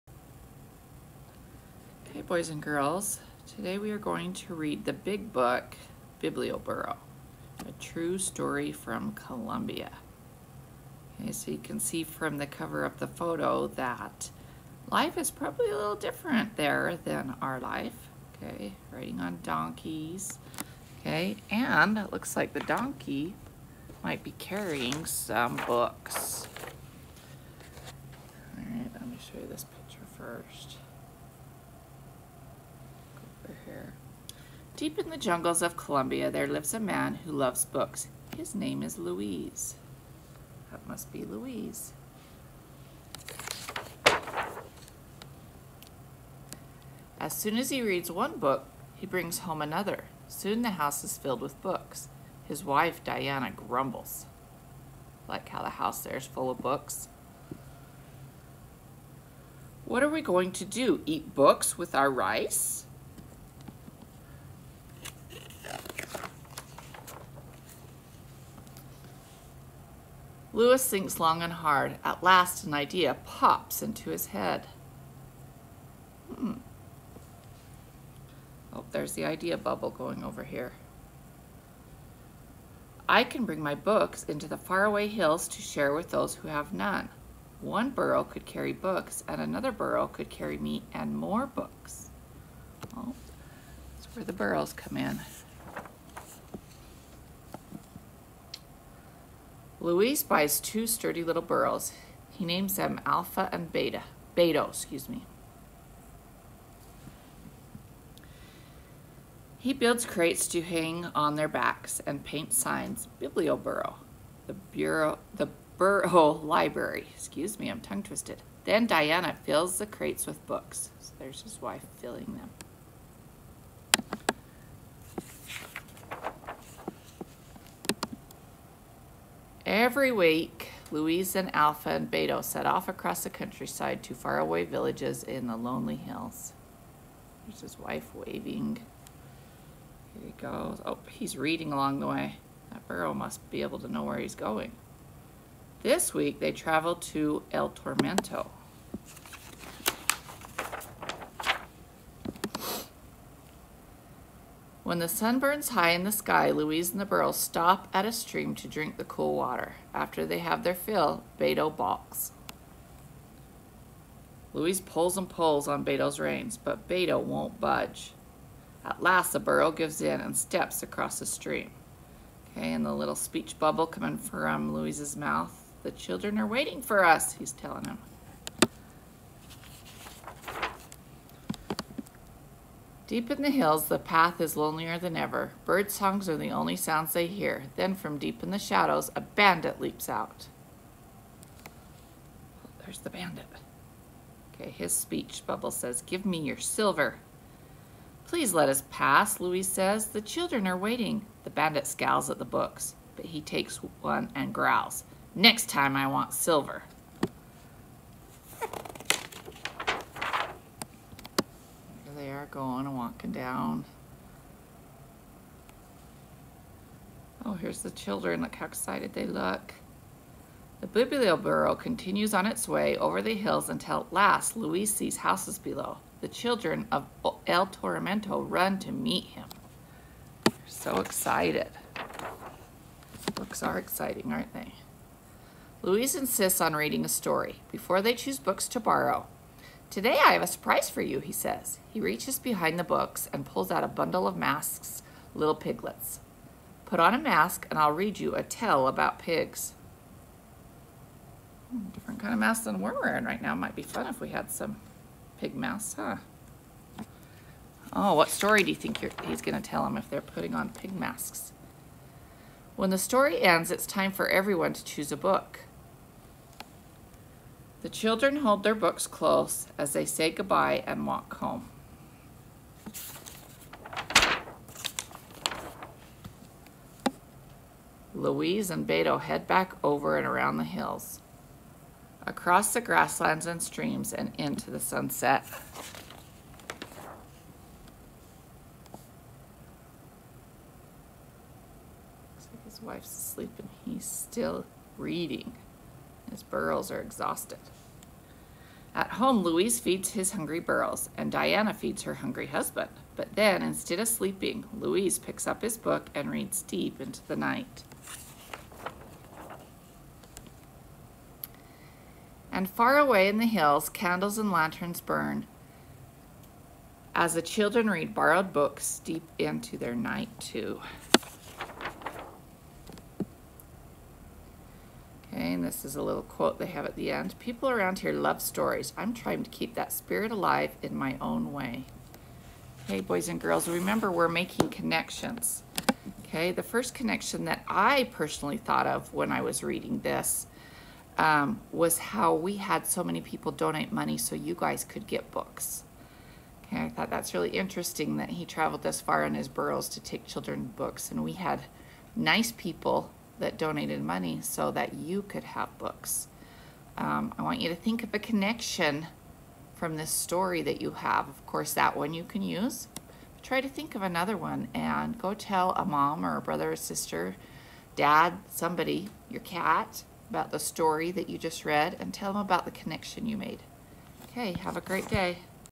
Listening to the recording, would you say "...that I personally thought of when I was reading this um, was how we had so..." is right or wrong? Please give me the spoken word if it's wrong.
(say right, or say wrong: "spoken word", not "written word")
right.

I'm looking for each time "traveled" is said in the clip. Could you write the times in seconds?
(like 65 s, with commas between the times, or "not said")
146 s, 348 s.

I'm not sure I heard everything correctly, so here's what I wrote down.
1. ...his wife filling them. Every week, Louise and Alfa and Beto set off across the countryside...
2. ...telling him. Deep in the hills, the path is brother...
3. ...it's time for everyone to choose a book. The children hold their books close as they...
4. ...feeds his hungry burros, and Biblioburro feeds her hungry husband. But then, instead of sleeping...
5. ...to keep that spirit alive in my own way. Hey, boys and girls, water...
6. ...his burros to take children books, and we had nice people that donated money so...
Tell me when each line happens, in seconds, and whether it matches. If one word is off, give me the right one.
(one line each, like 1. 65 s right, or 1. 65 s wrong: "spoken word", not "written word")
1. 121 s right
2. 177 s wrong: "lonelier", not "brother"
3. 263 s right
4. 299 s wrong: "Diana", not "Biblioburro"
5. 329 s wrong: "remember", not "water"
6. 349 s right.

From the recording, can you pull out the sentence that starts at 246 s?
Put on a mask and I'll read you a tale about pigs.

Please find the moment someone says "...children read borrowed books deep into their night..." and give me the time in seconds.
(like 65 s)
317 s.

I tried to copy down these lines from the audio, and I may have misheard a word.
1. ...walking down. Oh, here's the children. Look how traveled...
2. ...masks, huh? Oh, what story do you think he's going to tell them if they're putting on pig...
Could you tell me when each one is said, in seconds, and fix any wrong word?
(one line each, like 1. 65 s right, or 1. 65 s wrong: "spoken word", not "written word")
1. 212 s wrong: "excited", not "traveled"
2. 255 s right.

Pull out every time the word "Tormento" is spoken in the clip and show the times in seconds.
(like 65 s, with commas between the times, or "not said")
147 s, 227 s.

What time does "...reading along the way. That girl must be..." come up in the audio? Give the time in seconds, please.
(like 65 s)
141 s.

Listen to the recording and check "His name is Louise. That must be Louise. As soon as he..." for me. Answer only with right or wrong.
right.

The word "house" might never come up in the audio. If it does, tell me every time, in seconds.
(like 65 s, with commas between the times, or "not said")
50 s, 55 s, 225 s.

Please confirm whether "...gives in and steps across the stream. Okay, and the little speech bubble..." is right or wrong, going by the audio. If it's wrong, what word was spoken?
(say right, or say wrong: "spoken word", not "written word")
right.